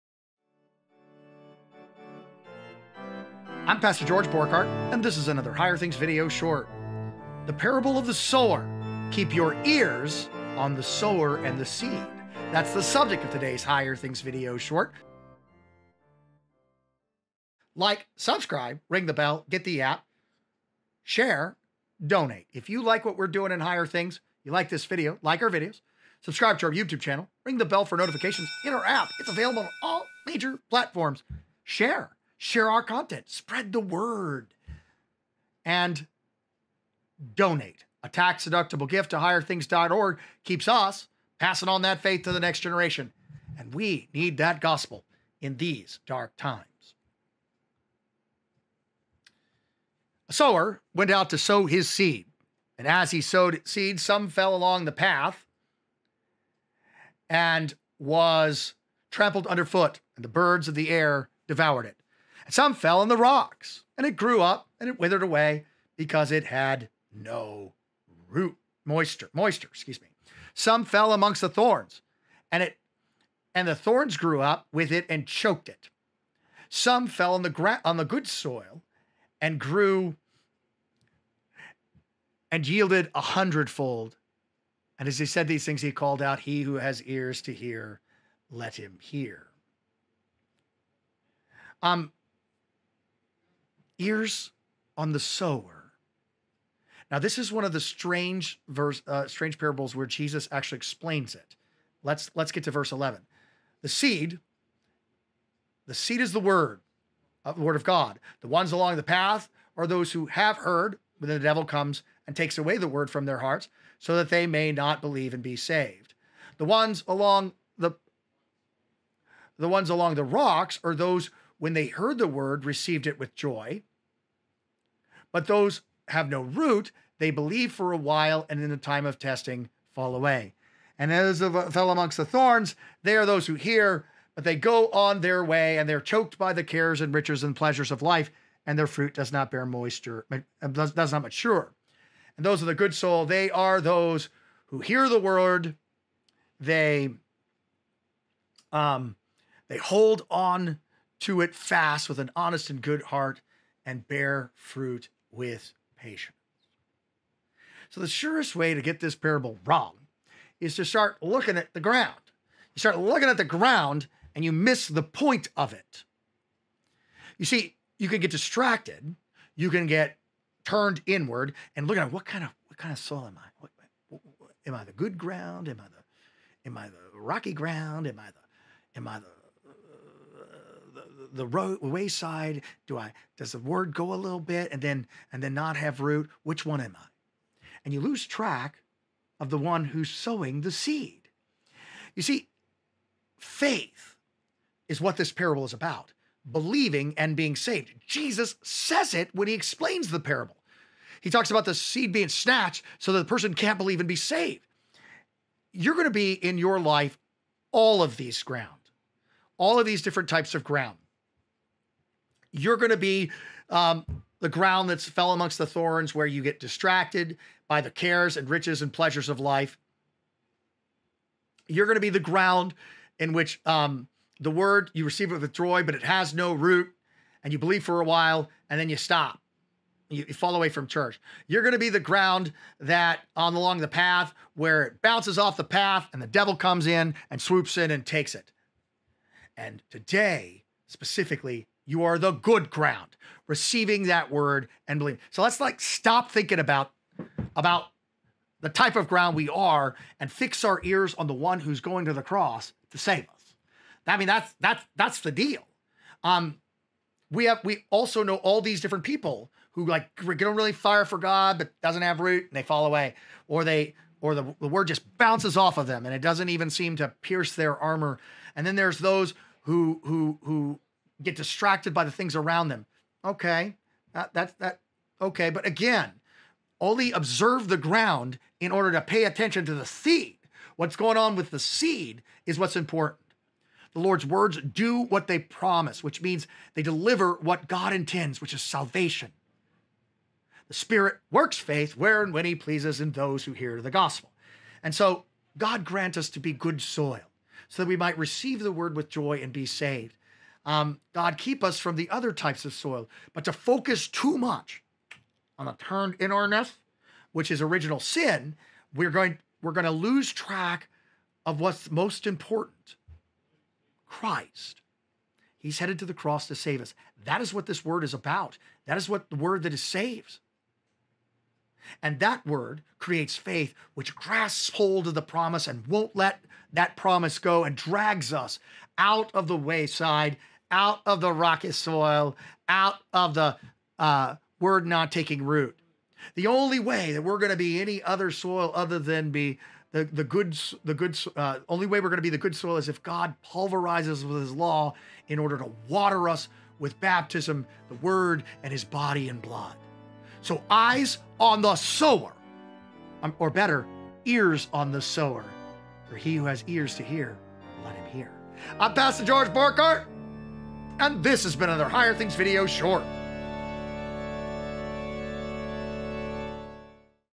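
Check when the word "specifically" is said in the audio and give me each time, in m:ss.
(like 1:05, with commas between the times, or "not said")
4:00.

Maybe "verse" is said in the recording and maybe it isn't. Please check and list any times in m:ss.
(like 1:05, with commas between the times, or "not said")
1:38, 1:42.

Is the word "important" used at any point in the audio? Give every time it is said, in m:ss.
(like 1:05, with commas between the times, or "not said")
4:42, 5:12.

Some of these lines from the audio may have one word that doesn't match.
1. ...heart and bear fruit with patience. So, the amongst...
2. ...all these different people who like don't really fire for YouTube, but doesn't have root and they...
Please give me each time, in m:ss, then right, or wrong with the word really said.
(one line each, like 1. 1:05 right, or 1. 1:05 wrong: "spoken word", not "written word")
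1. 2:33 wrong: "surest", not "amongst"
2. 4:18 wrong: "God", not "YouTube".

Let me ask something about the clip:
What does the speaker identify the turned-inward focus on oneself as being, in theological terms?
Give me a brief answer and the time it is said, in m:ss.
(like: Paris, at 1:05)
original sin, at 5:07.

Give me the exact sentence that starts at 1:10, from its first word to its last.
Some fell amongst the thorns, and it and the thorns grew up with it and choked it.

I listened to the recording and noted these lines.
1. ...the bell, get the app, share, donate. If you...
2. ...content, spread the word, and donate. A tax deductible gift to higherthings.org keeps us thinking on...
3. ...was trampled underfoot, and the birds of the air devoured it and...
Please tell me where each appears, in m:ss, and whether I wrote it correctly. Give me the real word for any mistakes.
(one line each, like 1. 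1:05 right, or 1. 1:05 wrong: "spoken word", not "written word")
1. 0:19 right
2. 0:32 wrong: "passing", not "thinking"
3. 0:57 right.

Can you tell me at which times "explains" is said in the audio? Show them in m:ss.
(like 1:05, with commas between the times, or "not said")
1:40, 3:19.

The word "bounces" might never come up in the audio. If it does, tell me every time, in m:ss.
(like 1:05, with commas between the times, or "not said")
3:55, 4:25.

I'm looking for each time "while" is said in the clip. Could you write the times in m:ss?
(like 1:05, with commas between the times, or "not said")
2:07, 3:48.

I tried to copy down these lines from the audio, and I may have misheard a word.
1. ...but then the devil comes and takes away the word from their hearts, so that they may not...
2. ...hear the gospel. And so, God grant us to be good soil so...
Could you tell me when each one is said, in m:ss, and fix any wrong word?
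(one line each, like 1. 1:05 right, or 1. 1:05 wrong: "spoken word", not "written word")
1. 1:51 right
2. 4:53 right.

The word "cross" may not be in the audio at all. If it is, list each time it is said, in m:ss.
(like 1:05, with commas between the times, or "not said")
4:12, 5:16.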